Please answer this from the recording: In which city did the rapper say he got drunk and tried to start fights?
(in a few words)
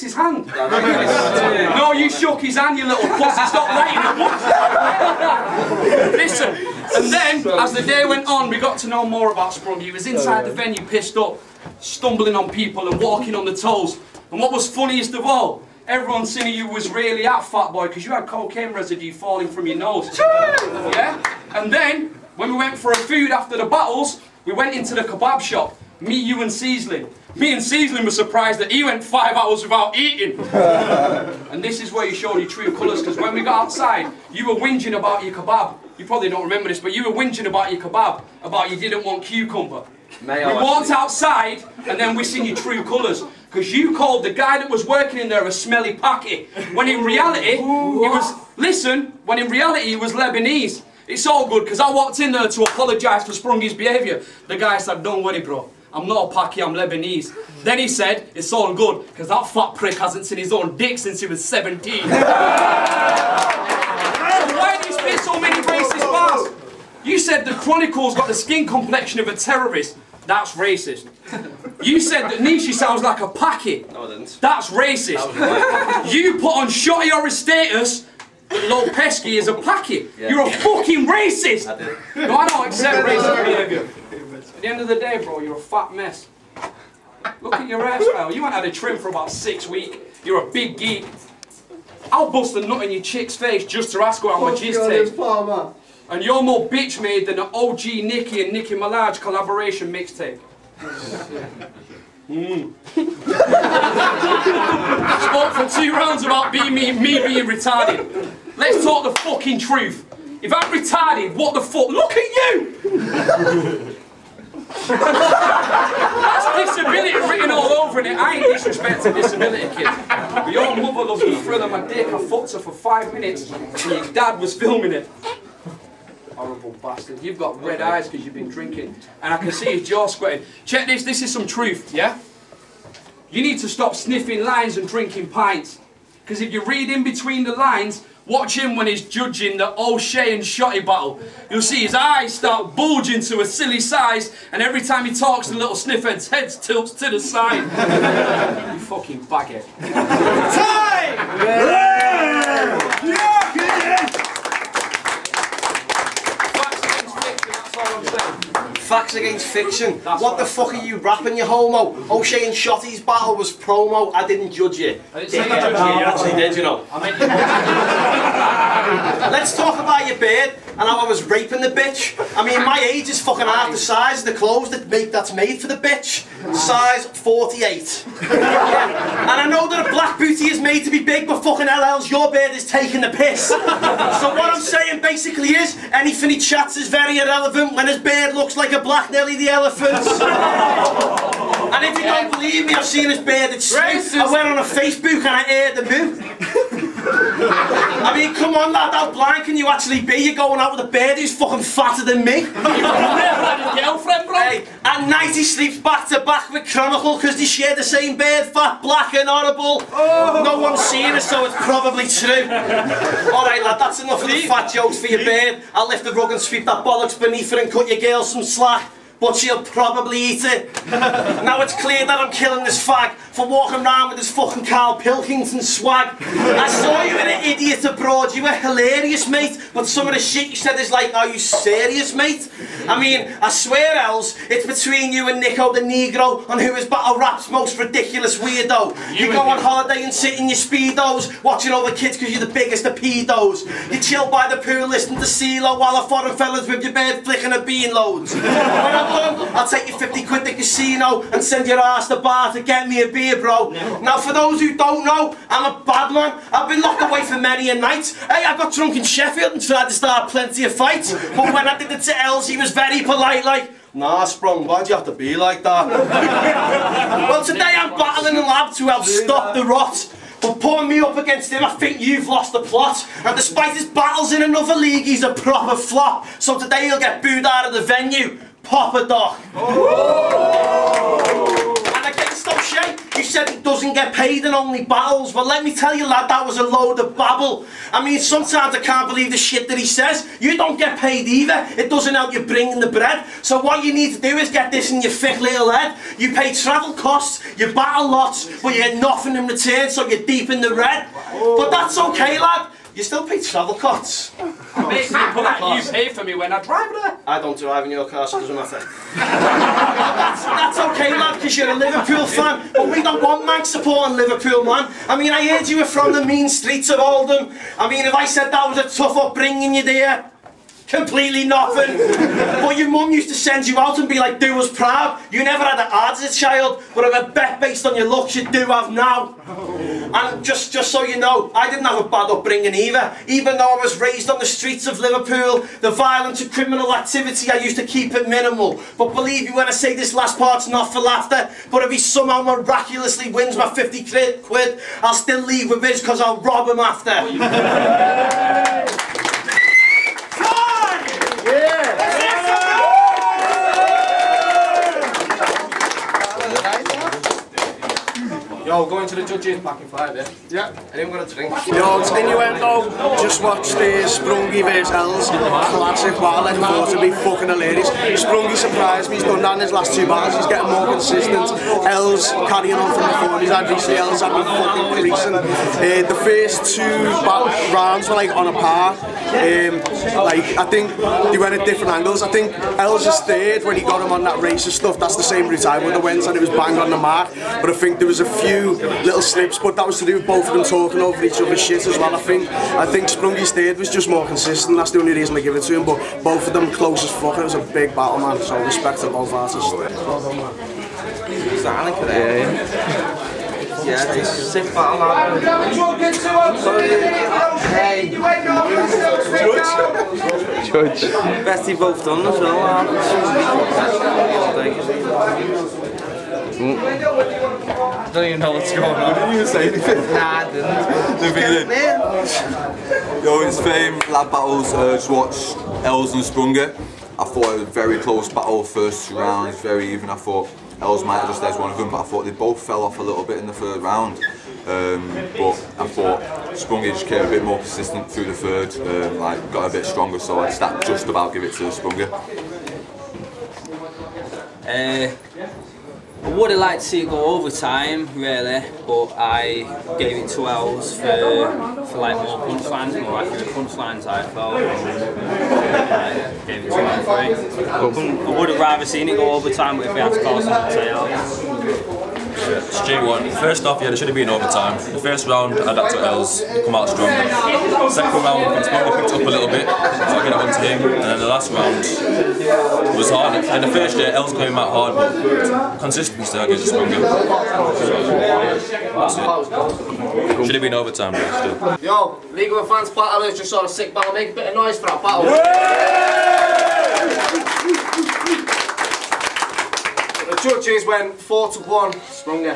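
Sheffield.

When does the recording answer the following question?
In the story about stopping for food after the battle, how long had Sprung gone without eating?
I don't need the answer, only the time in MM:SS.
00:29.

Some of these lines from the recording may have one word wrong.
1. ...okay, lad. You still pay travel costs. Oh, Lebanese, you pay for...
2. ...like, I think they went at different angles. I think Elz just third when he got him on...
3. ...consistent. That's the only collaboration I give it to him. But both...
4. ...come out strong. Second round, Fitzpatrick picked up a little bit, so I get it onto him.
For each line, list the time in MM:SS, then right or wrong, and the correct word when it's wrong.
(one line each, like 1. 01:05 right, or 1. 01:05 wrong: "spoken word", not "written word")
1. 05:01 wrong: "Mate", not "Lebanese"
2. 06:20 right
3. 06:34 wrong: "reason", not "collaboration"
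4. 07:46 right.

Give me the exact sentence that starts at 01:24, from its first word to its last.
At the end of the day, bro, you're a fat mess.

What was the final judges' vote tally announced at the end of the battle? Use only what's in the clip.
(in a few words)
4 to 1.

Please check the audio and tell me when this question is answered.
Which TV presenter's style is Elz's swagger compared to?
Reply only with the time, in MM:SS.
03:44.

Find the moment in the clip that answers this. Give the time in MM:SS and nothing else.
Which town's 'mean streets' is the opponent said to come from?
05:16.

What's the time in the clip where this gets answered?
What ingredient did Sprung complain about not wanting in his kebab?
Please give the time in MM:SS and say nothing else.
00:39.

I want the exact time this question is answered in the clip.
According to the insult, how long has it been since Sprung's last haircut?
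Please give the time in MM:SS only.
01:29.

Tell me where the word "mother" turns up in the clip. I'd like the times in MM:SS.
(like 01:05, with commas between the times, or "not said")
02:00.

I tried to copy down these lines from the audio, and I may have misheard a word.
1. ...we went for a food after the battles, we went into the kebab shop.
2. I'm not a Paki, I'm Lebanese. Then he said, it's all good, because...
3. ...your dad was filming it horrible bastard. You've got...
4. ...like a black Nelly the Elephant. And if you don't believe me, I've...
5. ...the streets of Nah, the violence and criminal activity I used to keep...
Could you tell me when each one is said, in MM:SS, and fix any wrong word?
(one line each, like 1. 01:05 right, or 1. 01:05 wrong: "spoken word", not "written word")
1. 00:22 right
2. 00:55 right
3. 02:03 right
4. 03:08 right
5. 05:34 wrong: "Liverpool", not "Nah".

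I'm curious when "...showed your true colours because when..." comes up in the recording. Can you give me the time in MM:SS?
00:32.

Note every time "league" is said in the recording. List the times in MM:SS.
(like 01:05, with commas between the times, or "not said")
04:34, 08:02.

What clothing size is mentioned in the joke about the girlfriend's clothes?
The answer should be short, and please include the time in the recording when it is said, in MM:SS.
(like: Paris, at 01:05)
48, at 02:57.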